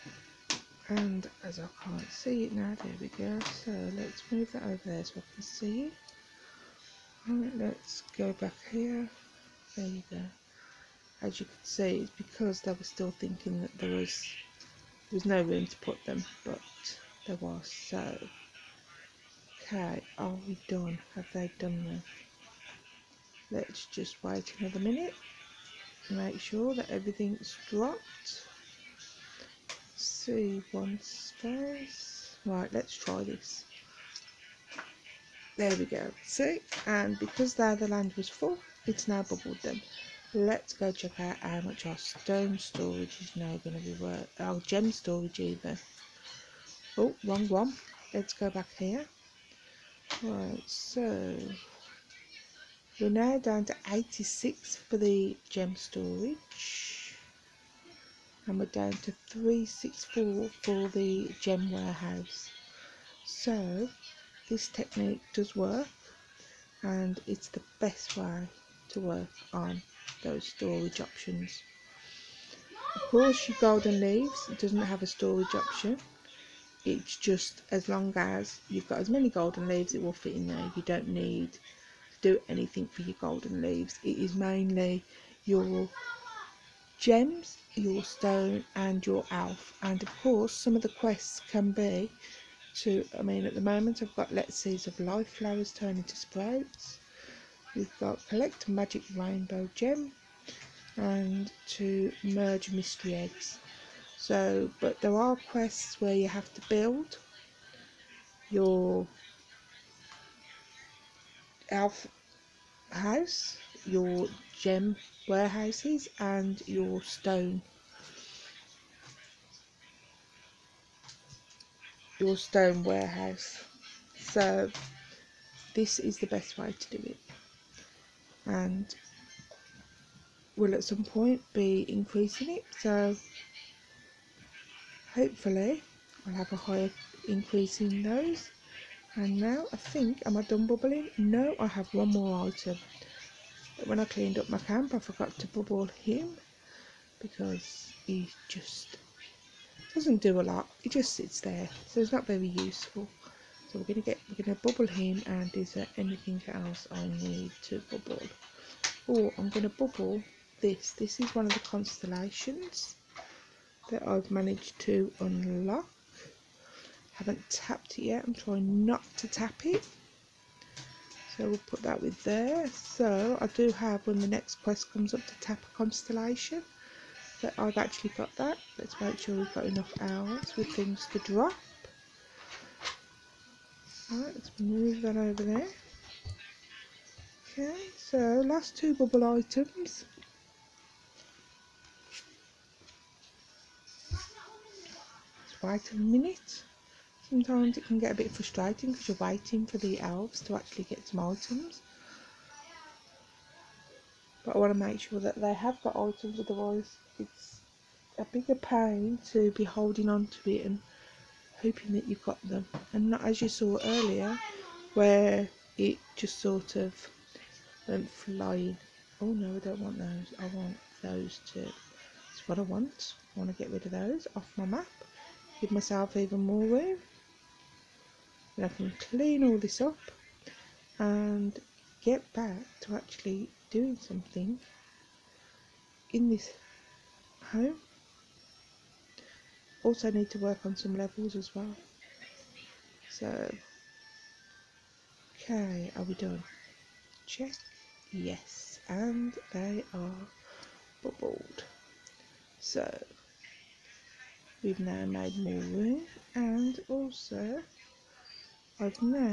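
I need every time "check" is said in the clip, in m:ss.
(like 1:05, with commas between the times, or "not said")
0:40, 4:07.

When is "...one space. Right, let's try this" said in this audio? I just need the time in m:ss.
0:30.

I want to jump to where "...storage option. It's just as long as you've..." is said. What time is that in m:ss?
1:15.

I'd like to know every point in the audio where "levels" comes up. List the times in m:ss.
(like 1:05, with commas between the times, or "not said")
4:00.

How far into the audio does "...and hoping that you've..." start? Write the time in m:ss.
3:30.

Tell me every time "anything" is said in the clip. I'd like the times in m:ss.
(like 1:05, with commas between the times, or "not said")
1:22, 2:35.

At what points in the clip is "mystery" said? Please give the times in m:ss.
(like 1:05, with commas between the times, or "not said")
1:42.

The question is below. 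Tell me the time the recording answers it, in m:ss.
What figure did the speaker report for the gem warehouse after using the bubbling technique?
0:59.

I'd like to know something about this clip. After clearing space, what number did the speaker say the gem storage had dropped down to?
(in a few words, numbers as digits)
86.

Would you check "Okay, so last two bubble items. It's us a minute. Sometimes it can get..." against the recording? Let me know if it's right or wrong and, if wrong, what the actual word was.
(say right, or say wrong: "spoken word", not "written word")
right.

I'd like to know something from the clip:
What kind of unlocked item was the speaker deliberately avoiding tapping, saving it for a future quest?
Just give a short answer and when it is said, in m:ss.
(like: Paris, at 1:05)
constellation, at 2:41.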